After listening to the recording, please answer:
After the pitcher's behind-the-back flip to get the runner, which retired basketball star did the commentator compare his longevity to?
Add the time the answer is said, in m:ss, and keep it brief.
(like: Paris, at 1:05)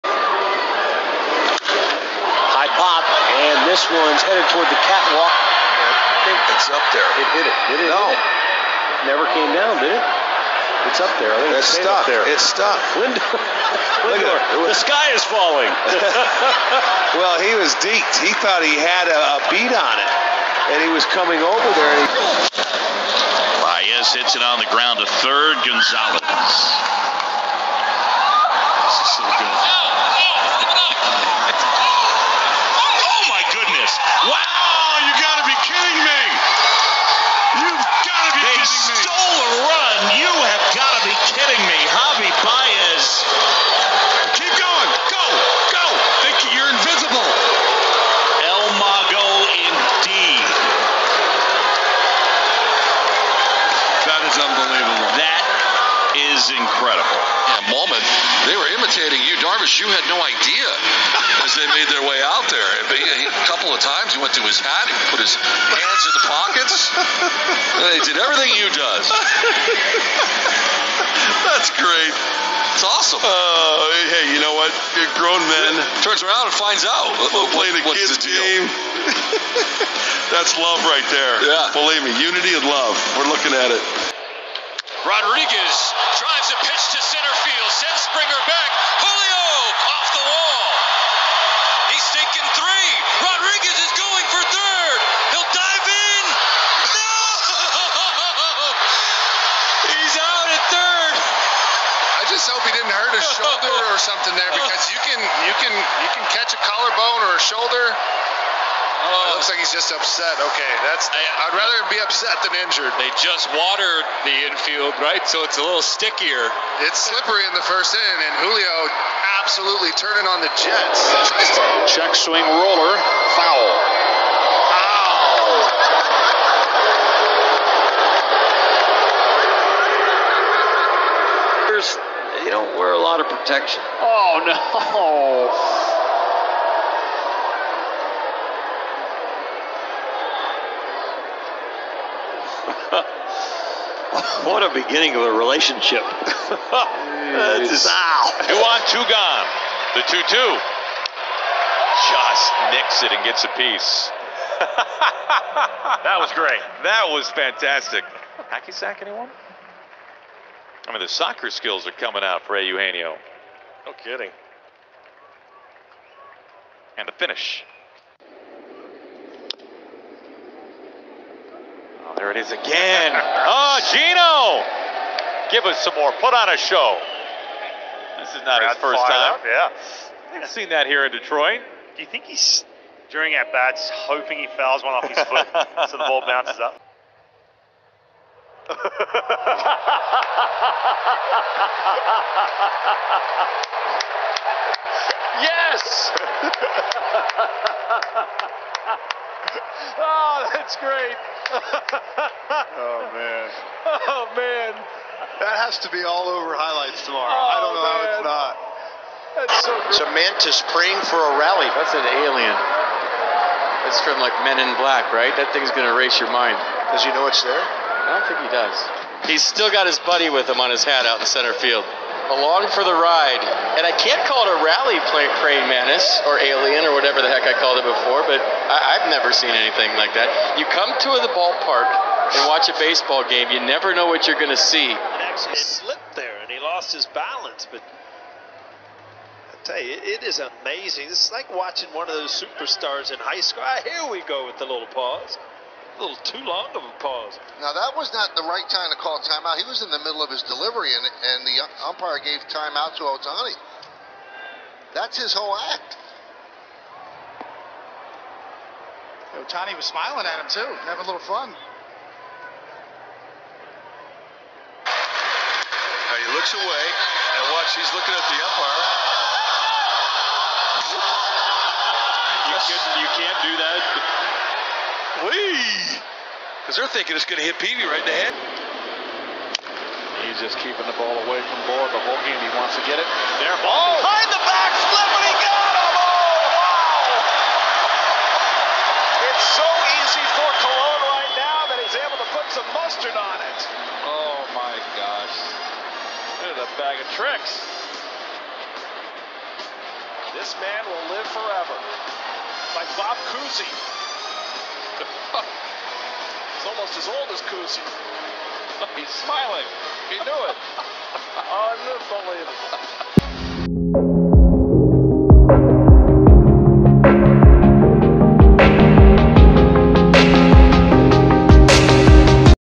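Bob Cousy, at 5:02.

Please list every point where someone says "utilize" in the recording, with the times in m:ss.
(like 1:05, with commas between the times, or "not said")
not said.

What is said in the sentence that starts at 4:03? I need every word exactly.
Ah, here we go with the little pause little too long of a pause.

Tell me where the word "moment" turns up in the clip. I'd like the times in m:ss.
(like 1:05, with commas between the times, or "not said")
0:57.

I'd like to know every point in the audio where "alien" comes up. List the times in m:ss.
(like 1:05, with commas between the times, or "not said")
3:32, 3:46.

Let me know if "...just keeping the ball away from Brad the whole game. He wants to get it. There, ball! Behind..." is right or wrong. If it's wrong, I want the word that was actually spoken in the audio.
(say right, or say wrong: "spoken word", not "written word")
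wrong: "Bohr", not "Brad".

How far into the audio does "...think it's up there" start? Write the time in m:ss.
0:06.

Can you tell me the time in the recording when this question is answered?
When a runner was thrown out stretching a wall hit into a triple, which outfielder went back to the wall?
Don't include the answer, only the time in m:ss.
1:28.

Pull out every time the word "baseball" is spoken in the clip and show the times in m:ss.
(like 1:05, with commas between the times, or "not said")
3:52.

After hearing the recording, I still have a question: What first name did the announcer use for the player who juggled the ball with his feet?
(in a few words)
Eugenio.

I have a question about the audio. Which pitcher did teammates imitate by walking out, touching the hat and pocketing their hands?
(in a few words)
Darvish.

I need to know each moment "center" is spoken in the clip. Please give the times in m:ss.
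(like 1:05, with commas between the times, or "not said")
1:27, 3:41.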